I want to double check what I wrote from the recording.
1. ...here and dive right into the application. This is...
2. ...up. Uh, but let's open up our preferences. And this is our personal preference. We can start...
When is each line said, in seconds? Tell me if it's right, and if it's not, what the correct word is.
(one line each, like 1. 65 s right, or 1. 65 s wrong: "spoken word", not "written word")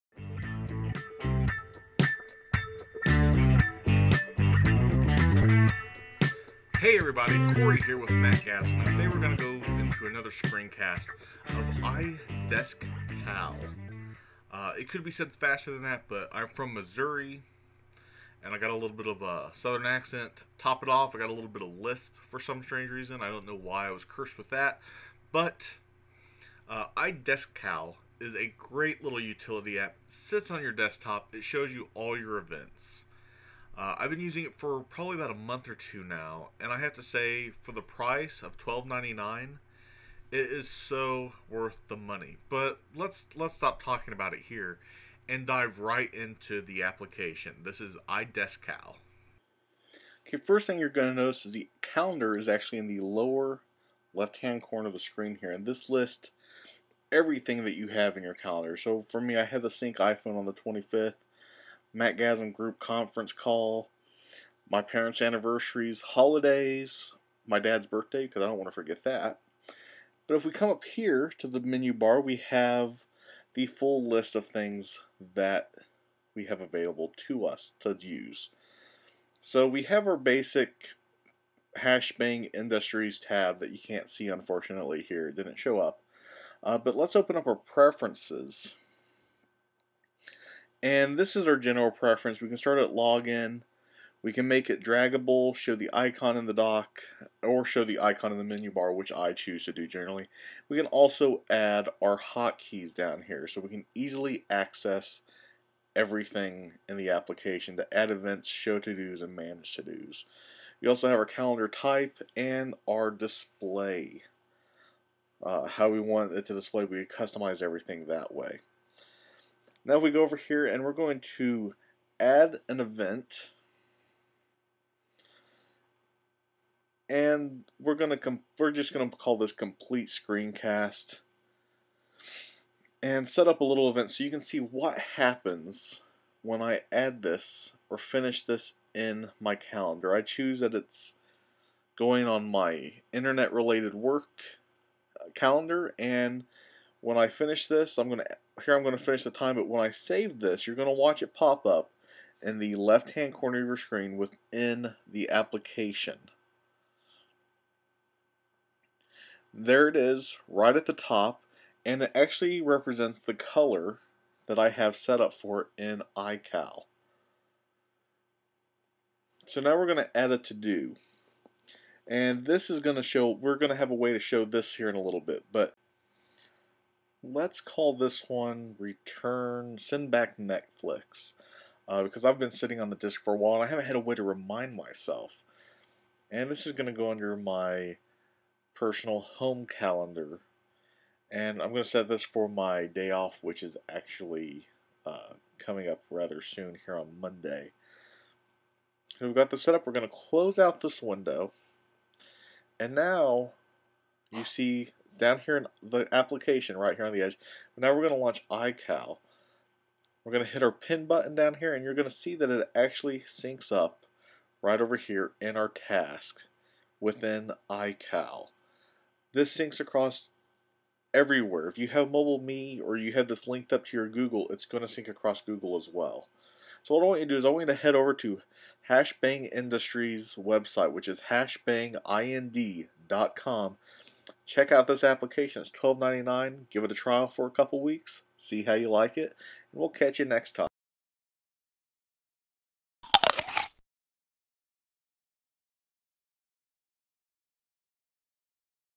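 1. 44 s right
2. 85 s wrong: "general", not "personal".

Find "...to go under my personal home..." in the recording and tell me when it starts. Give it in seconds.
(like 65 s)
186 s.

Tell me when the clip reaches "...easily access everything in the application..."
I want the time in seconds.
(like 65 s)
103 s.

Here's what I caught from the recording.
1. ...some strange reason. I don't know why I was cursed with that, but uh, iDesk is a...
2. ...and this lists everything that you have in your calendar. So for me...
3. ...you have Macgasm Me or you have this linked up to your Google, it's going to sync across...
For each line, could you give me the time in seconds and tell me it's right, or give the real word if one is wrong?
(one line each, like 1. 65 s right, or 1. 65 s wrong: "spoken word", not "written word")
1. 22 s right
2. 55 s right
3. 221 s wrong: "Mobile", not "Macgasm".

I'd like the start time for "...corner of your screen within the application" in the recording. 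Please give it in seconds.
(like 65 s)
153 s.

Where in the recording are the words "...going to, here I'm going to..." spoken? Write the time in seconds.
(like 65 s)
148 s.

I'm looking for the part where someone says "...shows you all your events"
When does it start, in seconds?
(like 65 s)
31 s.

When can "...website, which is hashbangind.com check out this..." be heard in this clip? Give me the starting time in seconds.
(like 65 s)
230 s.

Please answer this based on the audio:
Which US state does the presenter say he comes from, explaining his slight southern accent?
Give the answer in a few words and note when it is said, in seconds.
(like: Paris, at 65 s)
Missouri, at 16 s.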